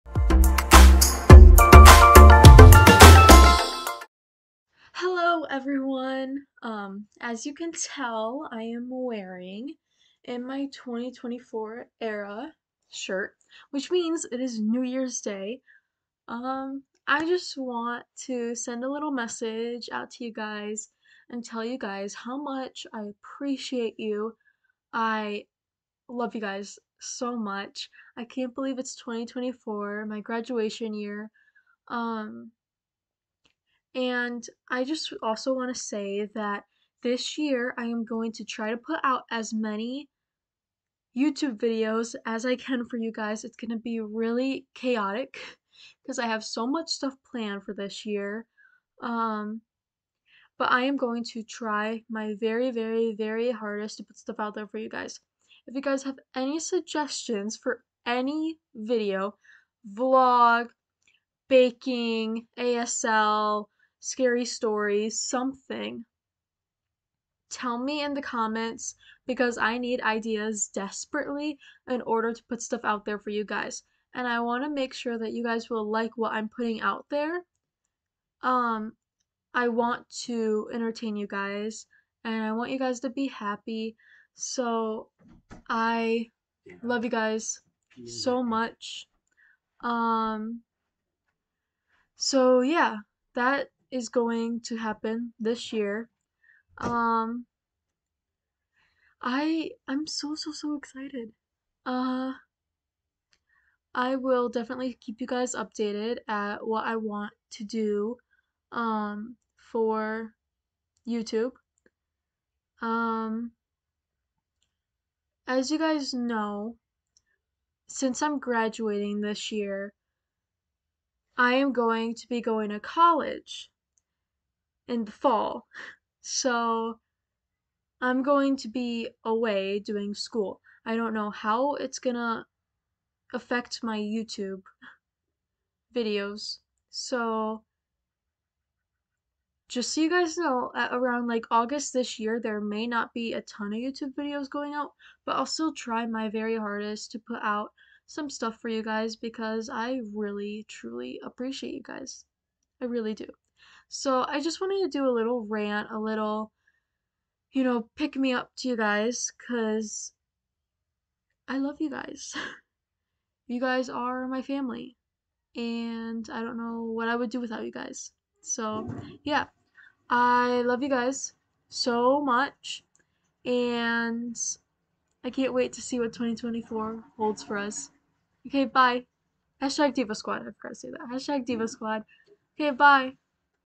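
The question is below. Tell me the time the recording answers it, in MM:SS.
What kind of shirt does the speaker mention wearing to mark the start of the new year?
00:10.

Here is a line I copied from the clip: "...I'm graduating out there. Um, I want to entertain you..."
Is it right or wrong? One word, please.
wrong.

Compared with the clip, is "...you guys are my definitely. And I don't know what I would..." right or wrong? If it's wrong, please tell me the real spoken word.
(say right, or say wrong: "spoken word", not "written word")
wrong: "family", not "definitely".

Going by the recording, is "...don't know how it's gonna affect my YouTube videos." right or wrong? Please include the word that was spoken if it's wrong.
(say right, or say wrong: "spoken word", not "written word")
right.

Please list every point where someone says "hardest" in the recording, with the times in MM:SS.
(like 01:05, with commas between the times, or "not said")
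00:53, 02:26.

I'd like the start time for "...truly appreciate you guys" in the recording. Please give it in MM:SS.
02:30.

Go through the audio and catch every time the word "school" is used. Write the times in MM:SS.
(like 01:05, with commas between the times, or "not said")
02:10.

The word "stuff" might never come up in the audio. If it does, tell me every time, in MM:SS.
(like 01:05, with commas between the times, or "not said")
00:46, 00:54, 01:12, 02:28.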